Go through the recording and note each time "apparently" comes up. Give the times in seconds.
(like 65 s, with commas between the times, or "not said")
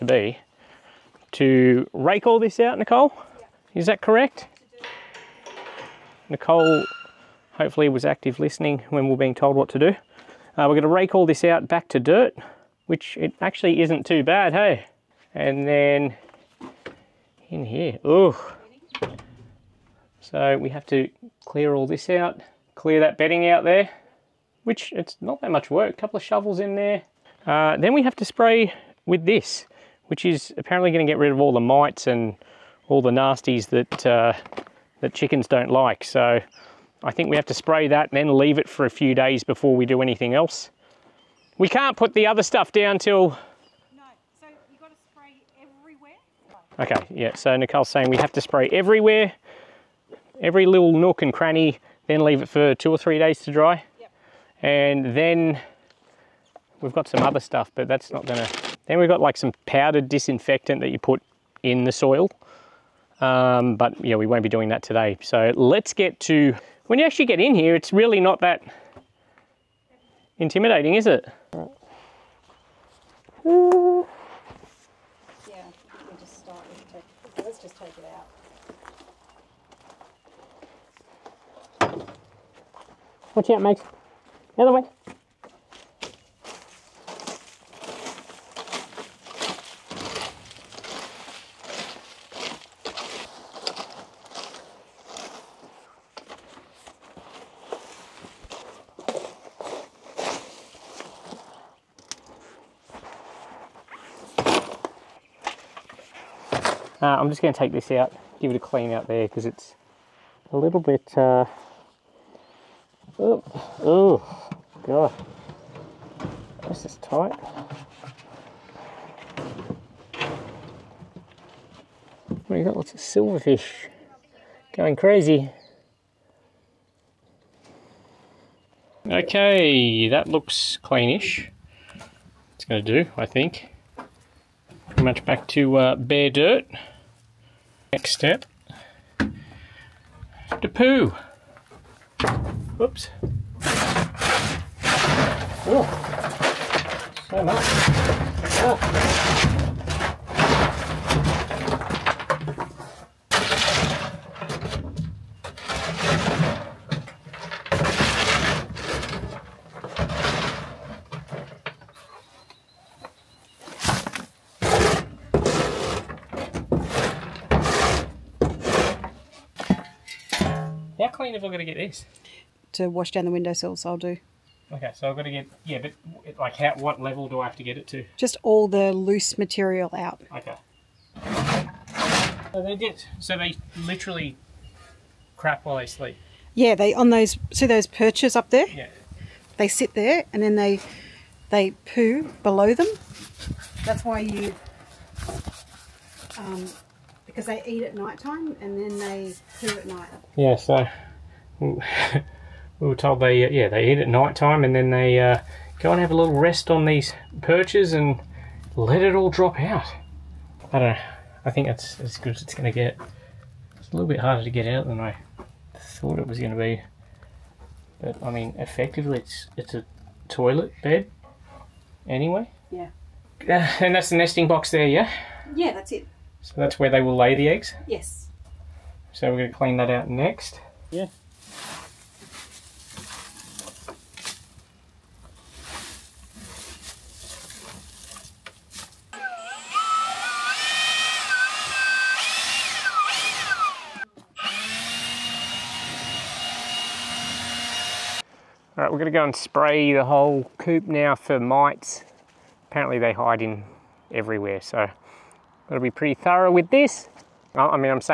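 30 s, 252 s.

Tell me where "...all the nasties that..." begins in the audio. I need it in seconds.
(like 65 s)
32 s.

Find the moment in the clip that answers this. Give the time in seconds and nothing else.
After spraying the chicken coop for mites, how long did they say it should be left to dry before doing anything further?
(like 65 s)
52 s.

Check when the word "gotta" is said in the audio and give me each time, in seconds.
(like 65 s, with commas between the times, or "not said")
255 s.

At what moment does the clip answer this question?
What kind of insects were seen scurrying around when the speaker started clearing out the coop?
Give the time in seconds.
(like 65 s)
122 s.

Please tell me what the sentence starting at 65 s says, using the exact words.
So let's get to when you actually get in here, it's really not that intimidating, is it?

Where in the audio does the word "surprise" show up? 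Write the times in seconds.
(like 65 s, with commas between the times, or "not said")
not said.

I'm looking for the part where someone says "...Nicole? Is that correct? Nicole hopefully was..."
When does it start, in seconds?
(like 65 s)
2 s.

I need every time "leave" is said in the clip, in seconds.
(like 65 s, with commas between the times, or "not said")
38 s, 52 s.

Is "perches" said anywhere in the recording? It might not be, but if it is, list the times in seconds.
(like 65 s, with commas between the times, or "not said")
187 s, 207 s.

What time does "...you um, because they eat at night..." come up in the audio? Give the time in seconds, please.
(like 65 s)
194 s.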